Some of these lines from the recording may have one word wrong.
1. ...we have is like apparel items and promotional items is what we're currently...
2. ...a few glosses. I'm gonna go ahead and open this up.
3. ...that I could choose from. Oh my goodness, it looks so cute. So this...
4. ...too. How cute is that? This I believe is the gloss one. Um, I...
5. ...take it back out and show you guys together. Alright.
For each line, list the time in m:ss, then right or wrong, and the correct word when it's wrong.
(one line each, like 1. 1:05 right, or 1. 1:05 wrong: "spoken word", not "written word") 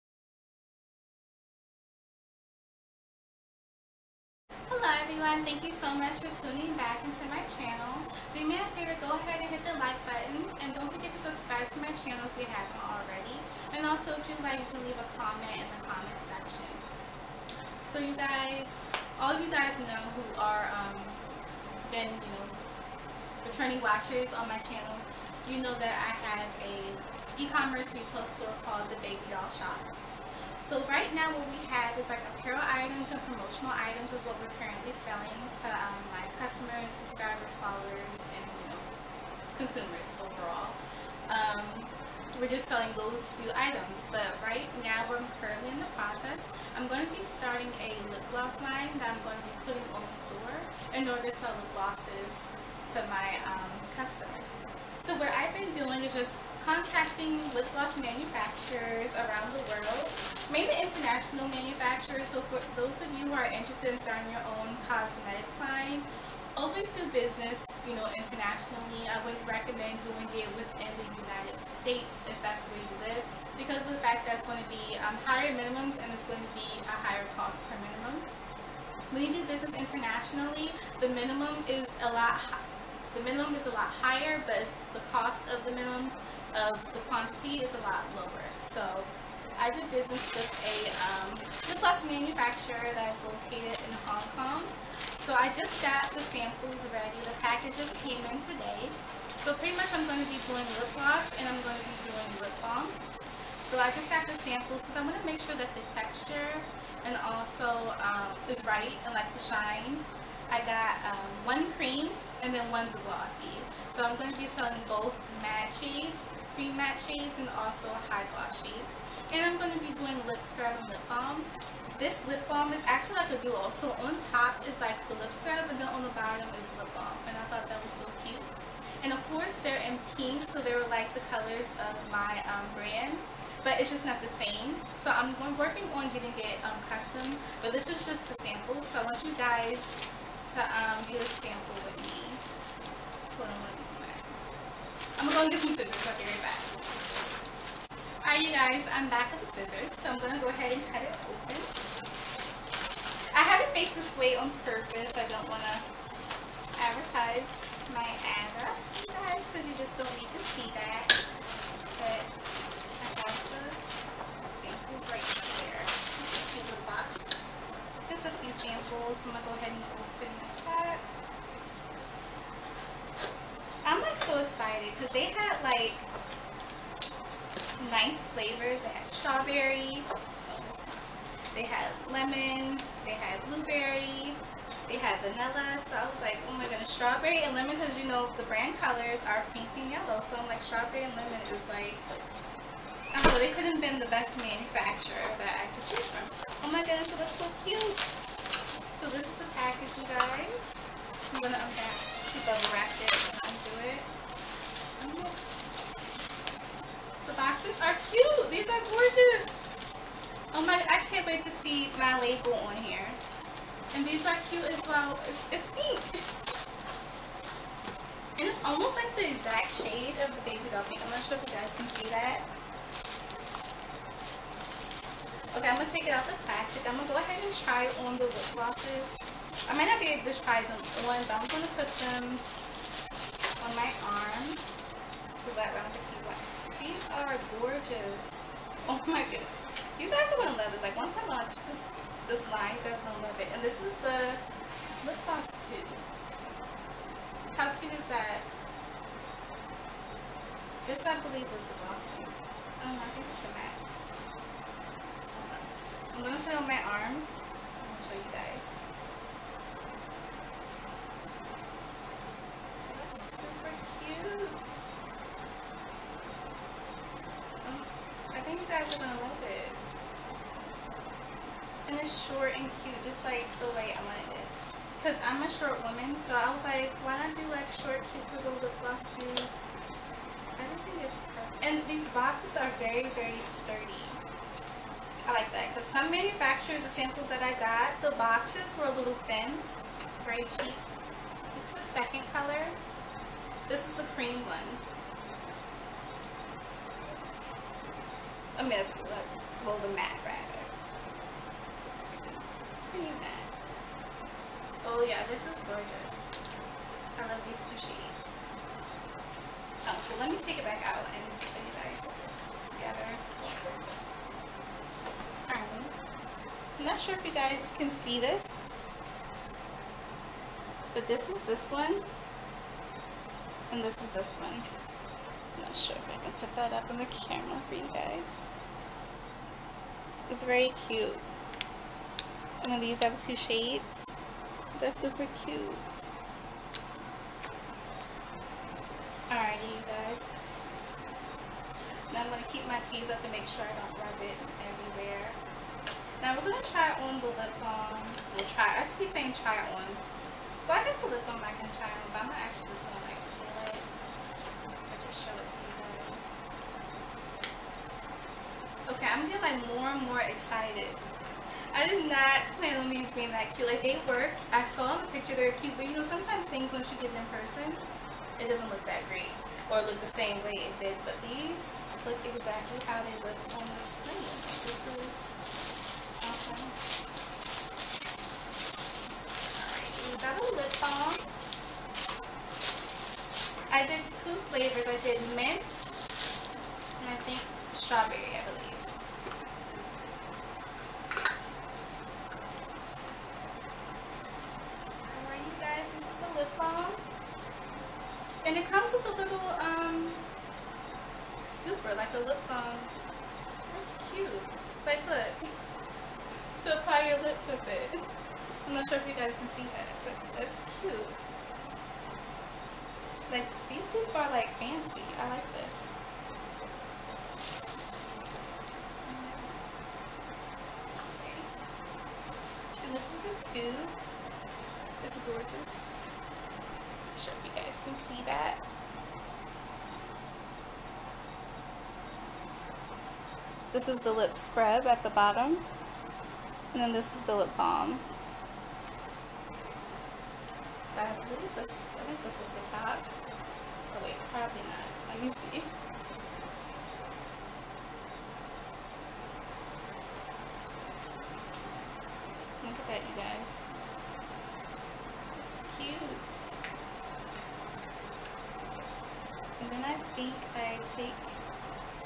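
1. 0:31 right
2. 2:48 wrong: "samples", not "glosses"
3. 3:15 right
4. 4:05 right
5. 5:10 right.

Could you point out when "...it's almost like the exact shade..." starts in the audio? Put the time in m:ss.
3:38.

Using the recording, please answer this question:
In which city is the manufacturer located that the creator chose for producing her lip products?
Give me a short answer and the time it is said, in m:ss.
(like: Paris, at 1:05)
Hong Kong, at 1:34.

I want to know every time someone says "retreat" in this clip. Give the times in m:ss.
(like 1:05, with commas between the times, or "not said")
not said.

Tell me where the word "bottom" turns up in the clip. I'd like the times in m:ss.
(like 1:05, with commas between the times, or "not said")
2:06, 7:15.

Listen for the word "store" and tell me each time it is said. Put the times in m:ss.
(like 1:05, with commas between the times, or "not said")
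0:28, 0:50.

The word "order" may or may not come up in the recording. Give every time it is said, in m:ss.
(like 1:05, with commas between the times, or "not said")
0:51.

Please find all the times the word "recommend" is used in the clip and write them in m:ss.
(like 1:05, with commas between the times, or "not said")
1:09.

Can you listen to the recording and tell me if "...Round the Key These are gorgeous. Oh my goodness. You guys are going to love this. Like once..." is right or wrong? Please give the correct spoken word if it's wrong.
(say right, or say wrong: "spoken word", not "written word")
right.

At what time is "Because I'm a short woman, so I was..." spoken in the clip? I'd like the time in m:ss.
4:34.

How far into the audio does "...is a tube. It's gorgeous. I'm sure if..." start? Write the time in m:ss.
7:03.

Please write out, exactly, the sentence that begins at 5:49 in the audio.
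So I guess the lip balm I can try on, but I'm not actually just going to like feel it.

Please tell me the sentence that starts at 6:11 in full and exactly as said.
But these look exactly how they look on the screen.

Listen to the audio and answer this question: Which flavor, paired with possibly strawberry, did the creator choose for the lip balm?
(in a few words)
Mint.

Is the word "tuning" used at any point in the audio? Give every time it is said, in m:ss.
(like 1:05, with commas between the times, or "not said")
0:06.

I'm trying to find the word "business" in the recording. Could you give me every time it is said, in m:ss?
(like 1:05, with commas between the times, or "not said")
1:07, 1:19, 1:29.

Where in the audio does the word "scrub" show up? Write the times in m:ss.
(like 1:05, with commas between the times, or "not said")
2:00, 2:05, 7:14.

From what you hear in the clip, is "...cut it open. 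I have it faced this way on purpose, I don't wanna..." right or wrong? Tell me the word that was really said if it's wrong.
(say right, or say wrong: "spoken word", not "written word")
right.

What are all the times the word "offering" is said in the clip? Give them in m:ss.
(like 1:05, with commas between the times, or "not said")
not said.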